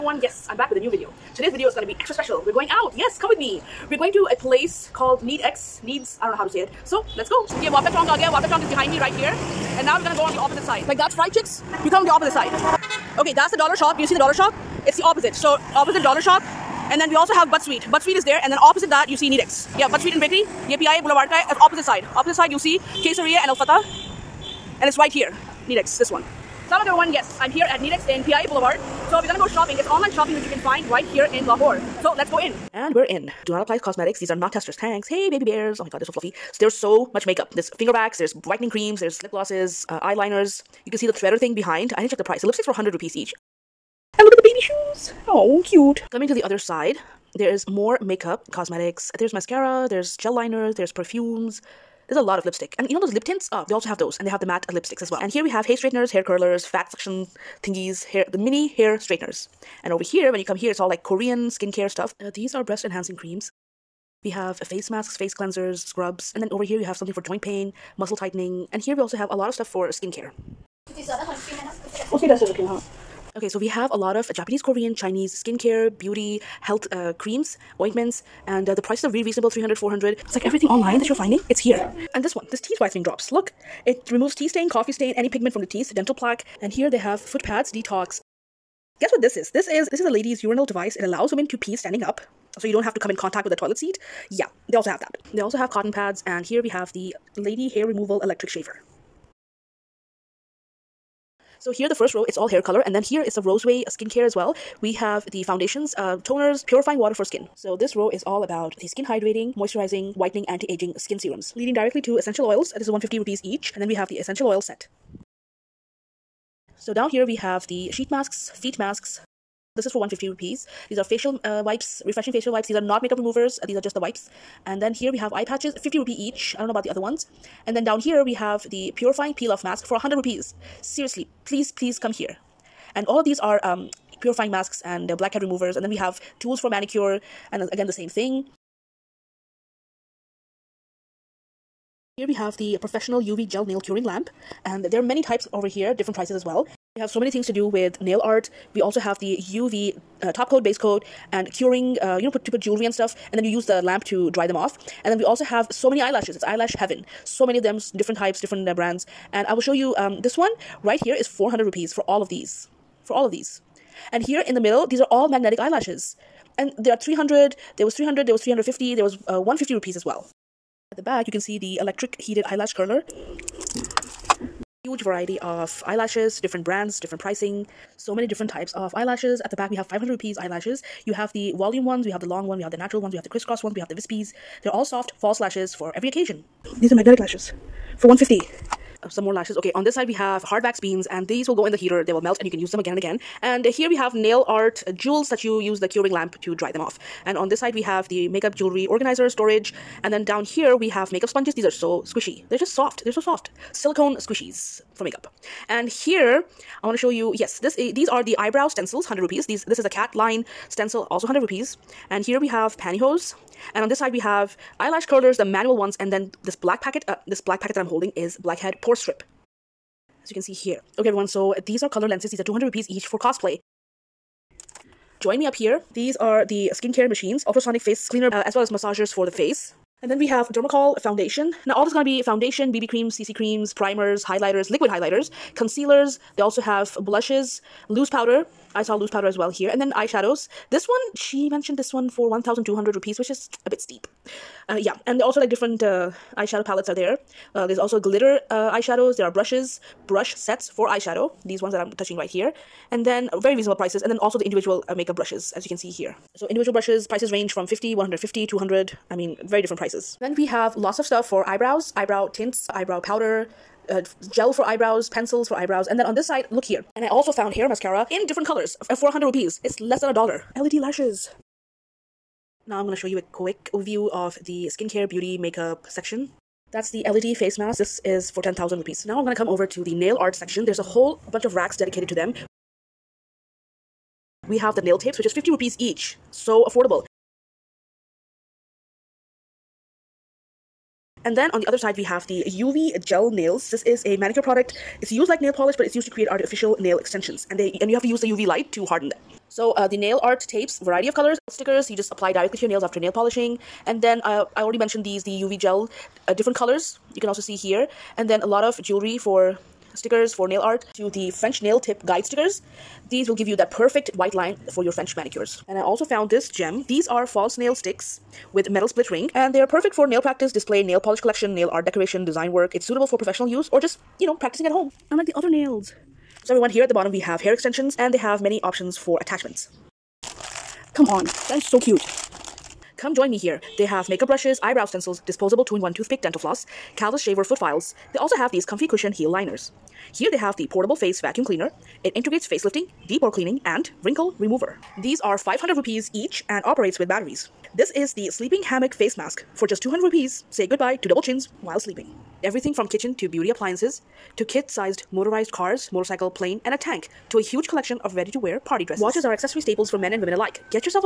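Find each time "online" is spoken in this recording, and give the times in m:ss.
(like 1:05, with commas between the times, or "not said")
0:29, 1:20.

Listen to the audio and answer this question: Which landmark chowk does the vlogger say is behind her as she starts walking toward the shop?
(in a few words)
Wapda Chowk.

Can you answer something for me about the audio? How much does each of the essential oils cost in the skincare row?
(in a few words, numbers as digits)
150 rupees.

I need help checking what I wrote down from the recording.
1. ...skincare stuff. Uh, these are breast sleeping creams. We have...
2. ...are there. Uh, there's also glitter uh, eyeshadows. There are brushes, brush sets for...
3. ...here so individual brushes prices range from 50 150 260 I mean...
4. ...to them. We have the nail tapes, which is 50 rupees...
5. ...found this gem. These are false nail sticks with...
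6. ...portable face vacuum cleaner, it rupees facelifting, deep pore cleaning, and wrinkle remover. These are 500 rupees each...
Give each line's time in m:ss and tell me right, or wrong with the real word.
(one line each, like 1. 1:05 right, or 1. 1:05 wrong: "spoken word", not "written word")
1. 1:01 wrong: "enhancing", not "sleeping"
2. 4:06 right
3. 4:15 wrong: "200", not "260"
4. 4:42 right
5. 5:16 right
6. 5:40 wrong: "integrates", not "rupees".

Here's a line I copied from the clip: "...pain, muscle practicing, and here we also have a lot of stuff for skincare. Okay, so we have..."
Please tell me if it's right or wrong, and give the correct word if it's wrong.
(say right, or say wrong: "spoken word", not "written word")
wrong: "tightening", not "practicing".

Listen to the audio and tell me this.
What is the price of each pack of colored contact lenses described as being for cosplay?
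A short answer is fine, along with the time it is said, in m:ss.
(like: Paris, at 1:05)
200 rupees, at 3:42.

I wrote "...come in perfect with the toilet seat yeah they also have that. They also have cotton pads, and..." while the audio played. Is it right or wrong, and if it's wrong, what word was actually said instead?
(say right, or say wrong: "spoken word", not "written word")
wrong: "contact", not "perfect".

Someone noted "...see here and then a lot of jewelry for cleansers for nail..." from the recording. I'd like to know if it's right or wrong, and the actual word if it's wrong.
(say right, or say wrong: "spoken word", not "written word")
wrong: "stickers", not "cleansers".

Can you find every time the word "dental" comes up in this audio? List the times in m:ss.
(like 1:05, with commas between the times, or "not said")
1:25, 5:36.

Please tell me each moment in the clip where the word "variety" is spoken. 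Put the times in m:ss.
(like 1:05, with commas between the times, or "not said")
2:55, 5:00.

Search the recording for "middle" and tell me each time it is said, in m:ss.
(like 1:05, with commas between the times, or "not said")
2:44.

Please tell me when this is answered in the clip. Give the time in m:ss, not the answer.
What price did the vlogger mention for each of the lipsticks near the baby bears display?
0:42.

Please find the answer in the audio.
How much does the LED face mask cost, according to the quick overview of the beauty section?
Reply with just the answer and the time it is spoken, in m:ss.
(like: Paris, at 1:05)
10,000 rupees, at 4:38.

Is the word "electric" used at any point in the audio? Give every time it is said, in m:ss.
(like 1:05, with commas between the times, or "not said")
1:38, 2:51.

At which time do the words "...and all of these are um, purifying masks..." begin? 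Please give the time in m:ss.
2:12.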